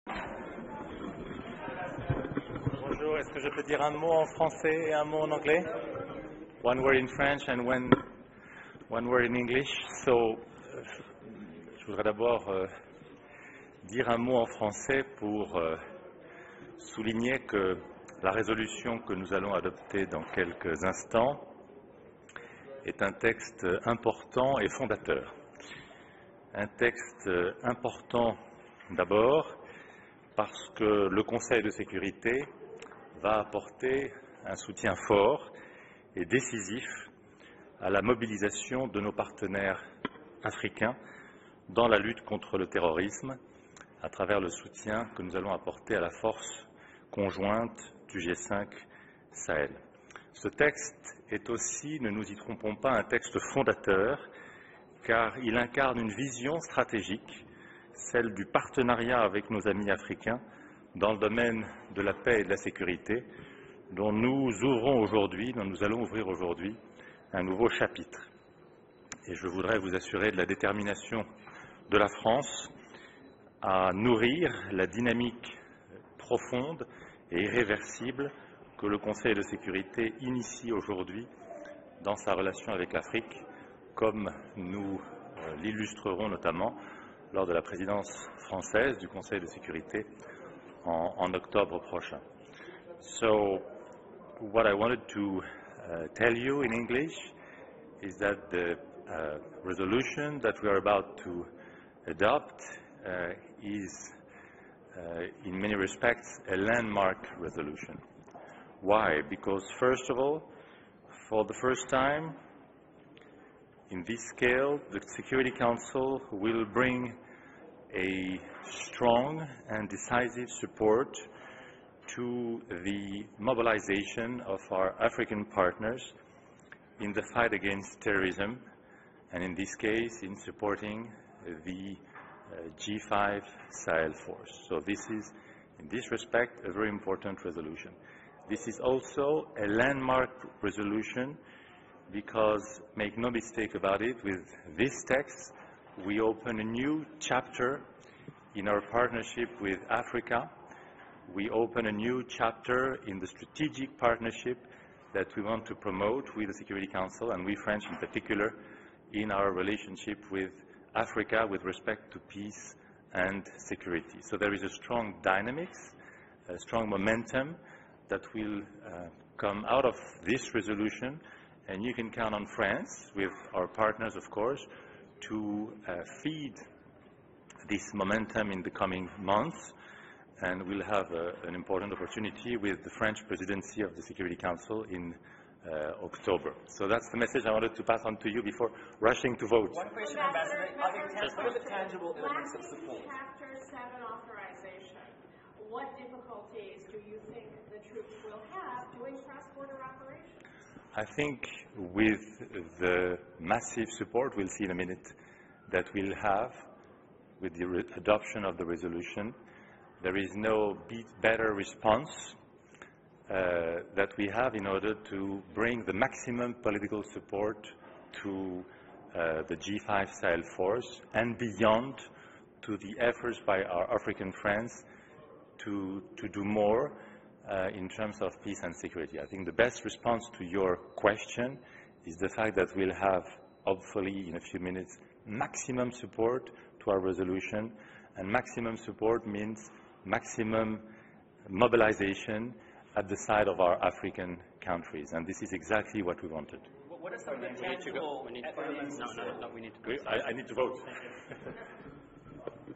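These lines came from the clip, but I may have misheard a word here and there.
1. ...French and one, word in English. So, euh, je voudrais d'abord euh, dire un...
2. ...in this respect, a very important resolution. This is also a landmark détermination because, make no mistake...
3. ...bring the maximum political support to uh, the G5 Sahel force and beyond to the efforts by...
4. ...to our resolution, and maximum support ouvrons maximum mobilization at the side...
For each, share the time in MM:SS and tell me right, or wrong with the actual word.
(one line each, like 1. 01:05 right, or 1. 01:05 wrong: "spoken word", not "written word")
1. 00:07 right
2. 02:15 wrong: "resolution", not "détermination"
3. 03:35 right
4. 03:56 wrong: "means", not "ouvrons".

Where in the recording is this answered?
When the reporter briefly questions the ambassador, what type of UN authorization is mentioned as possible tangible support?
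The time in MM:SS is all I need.
03:13.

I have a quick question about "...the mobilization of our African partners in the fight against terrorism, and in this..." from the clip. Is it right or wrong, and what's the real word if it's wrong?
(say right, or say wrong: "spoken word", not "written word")
right.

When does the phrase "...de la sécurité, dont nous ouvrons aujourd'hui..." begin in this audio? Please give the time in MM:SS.
01:02.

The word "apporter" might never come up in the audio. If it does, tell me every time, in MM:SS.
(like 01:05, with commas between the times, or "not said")
00:33, 00:45.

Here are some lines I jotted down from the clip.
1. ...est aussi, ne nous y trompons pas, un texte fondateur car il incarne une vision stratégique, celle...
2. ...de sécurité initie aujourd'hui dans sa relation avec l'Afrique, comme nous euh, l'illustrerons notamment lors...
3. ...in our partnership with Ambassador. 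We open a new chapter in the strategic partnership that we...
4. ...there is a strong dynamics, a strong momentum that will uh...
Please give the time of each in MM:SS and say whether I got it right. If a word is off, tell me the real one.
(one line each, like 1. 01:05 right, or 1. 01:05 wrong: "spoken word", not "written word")
1. 00:51 right
2. 01:19 right
3. 02:28 wrong: "Africa", not "Ambassador"
4. 02:44 right.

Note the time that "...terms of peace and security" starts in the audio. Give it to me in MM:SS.
03:47.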